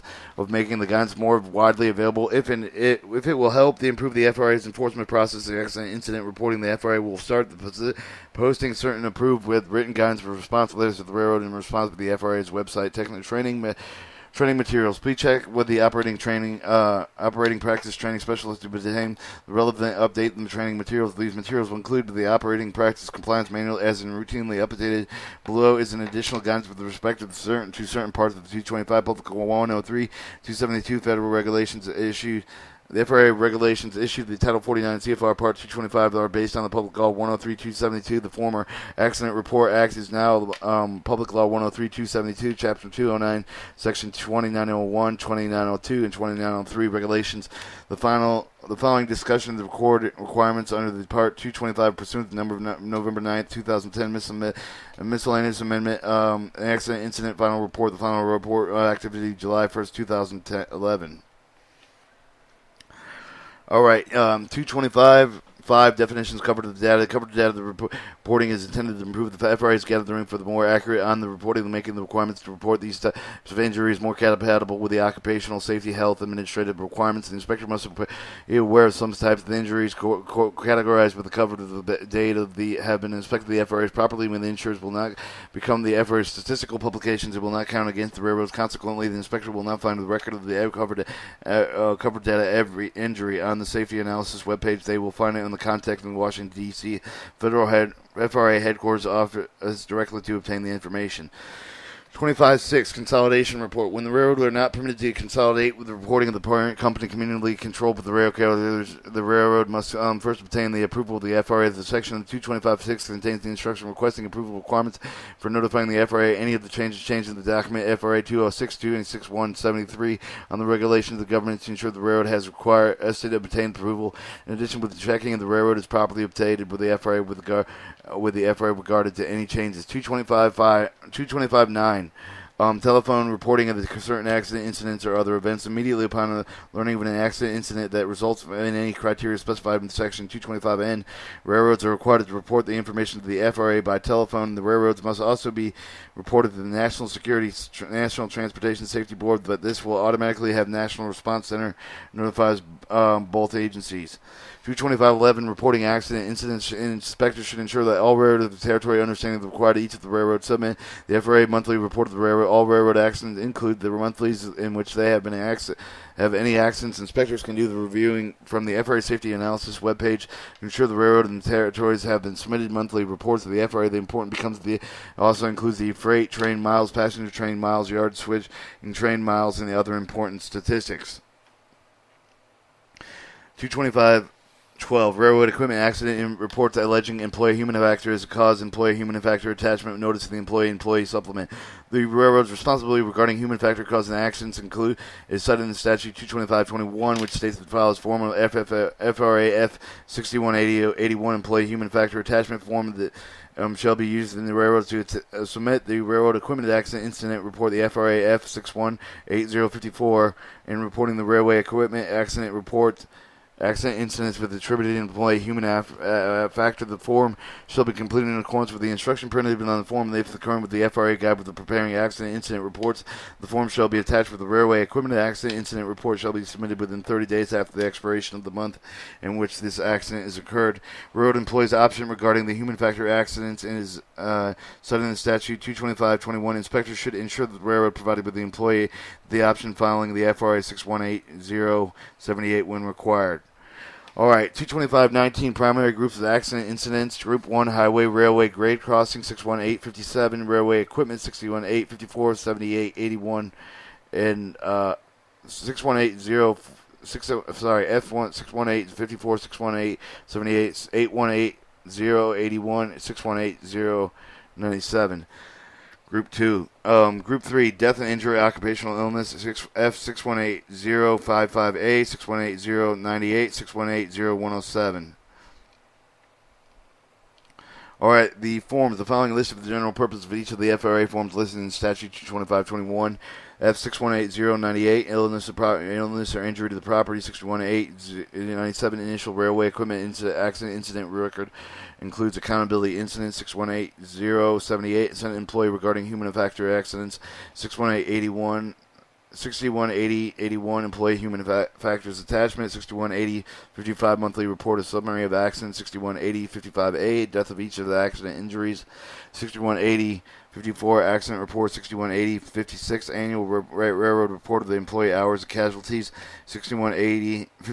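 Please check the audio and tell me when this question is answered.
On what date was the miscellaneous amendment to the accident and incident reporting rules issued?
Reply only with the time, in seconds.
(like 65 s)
52 s.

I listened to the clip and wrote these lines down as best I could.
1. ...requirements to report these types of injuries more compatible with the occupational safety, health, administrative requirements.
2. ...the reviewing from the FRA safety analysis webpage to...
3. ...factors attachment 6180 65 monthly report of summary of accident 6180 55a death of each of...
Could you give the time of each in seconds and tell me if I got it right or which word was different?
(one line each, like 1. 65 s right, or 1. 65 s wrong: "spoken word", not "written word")
1. 72 s right
2. 167 s right
3. 301 s wrong: "55", not "65".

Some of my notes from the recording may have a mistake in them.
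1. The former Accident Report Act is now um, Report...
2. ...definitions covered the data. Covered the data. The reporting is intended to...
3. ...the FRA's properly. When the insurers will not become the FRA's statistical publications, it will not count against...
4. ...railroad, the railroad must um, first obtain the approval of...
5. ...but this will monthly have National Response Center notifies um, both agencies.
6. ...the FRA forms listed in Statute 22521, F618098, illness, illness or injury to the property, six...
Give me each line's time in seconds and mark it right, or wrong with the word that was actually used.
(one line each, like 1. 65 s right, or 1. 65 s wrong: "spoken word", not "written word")
1. 38 s wrong: "Public", not "Report"
2. 65 s right
3. 83 s right
4. 108 s right
5. 149 s wrong: "automatically", not "monthly"
6. 280 s right.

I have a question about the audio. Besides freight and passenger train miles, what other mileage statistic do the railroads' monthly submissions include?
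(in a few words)
yard switch and train miles.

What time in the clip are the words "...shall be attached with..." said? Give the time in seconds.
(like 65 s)
223 s.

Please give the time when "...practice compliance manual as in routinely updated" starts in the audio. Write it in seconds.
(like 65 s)
22 s.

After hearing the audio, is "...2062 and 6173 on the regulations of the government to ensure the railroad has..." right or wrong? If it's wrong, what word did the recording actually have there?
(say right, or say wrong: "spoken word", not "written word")
right.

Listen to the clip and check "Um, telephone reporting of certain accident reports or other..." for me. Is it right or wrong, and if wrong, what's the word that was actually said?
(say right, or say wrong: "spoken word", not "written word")
wrong: "incidents", not "reports".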